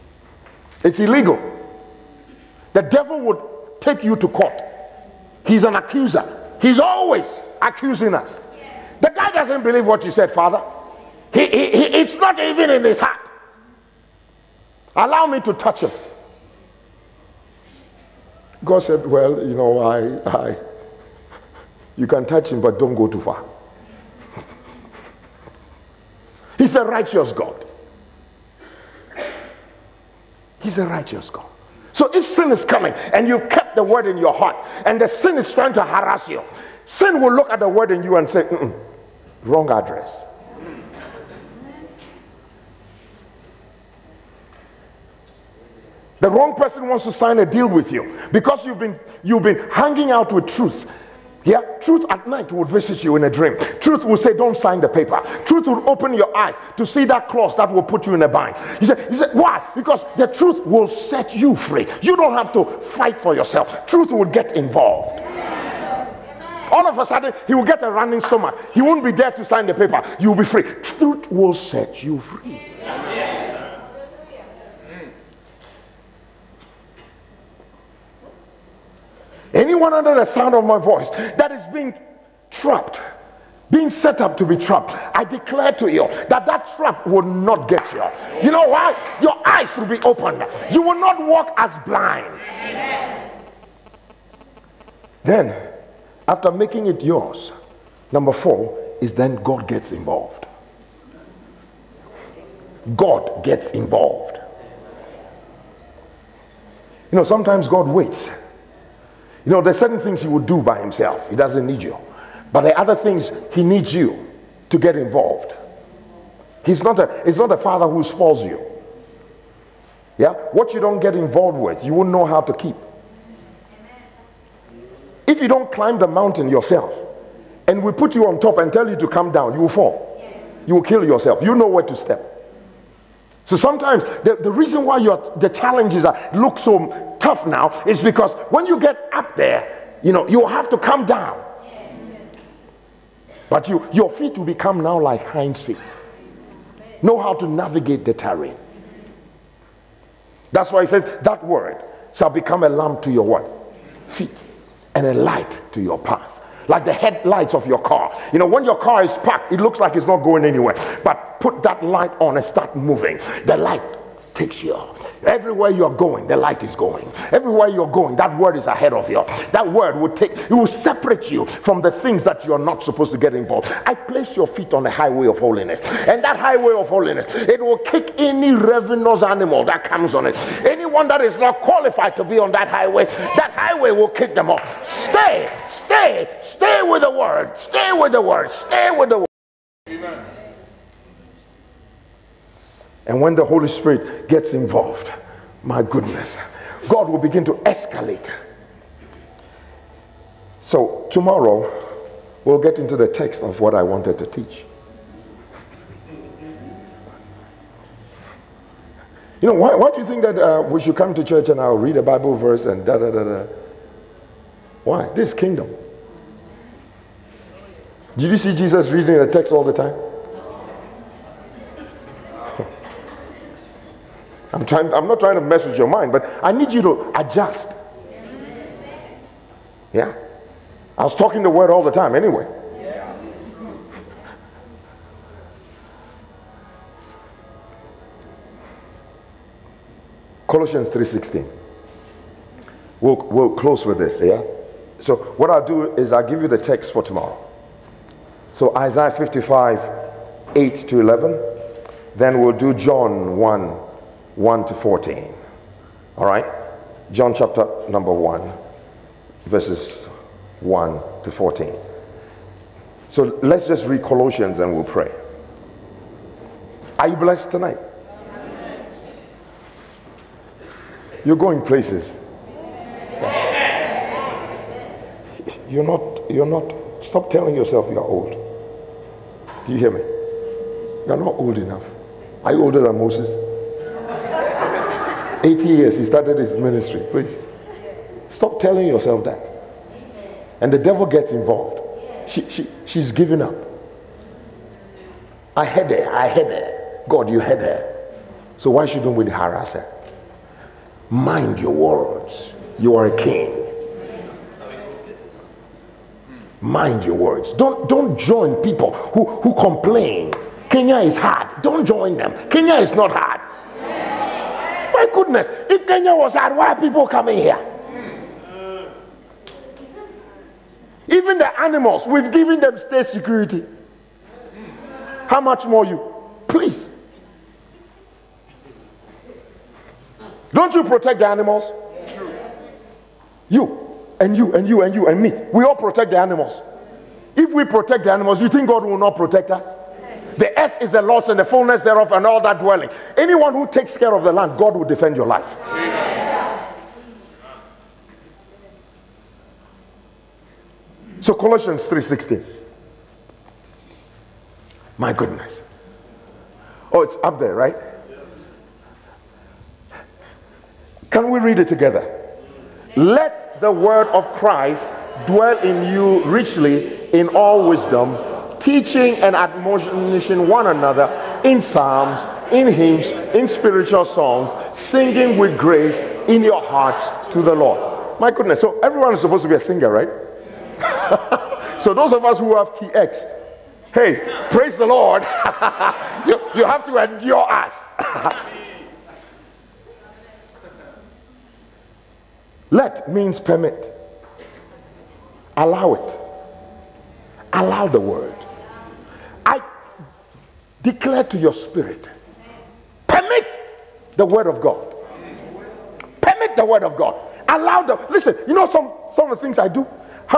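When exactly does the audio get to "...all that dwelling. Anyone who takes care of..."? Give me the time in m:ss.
5:42.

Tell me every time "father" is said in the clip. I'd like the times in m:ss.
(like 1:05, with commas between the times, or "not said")
0:10, 1:57.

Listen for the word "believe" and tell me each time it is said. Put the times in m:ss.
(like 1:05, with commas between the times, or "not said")
0:09.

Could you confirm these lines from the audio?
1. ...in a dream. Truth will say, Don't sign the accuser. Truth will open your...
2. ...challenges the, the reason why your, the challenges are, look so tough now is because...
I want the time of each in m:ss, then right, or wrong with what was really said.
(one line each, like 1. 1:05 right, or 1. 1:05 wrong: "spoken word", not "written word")
1. 0:53 wrong: "paper", not "accuser"
2. 2:13 wrong: "sometimes", not "challenges".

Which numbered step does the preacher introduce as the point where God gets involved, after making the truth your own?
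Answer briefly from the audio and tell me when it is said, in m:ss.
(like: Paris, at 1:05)
4, at 1:38.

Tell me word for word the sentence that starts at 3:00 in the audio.
Anyone that is not qualified to be on that highway, that highway will kick them off.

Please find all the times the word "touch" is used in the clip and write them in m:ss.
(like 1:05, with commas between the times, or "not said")
0:15, 0:22.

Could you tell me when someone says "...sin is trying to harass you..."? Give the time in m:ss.
0:35.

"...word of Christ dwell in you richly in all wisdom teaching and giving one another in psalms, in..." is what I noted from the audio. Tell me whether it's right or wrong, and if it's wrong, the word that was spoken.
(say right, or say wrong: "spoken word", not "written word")
wrong: "admonishing", not "giving".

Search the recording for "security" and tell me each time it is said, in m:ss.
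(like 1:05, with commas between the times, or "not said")
5:23.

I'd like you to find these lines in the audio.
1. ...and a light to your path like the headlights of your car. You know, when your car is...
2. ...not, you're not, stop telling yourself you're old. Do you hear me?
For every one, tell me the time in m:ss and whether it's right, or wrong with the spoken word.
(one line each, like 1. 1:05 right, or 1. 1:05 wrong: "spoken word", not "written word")
1. 2:34 right
2. 4:35 right.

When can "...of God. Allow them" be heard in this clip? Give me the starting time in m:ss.
6:46.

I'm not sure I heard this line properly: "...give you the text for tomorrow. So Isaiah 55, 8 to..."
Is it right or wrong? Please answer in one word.
right.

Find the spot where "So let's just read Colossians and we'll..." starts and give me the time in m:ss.
4:23.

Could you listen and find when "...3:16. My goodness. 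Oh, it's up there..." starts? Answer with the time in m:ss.
5:51.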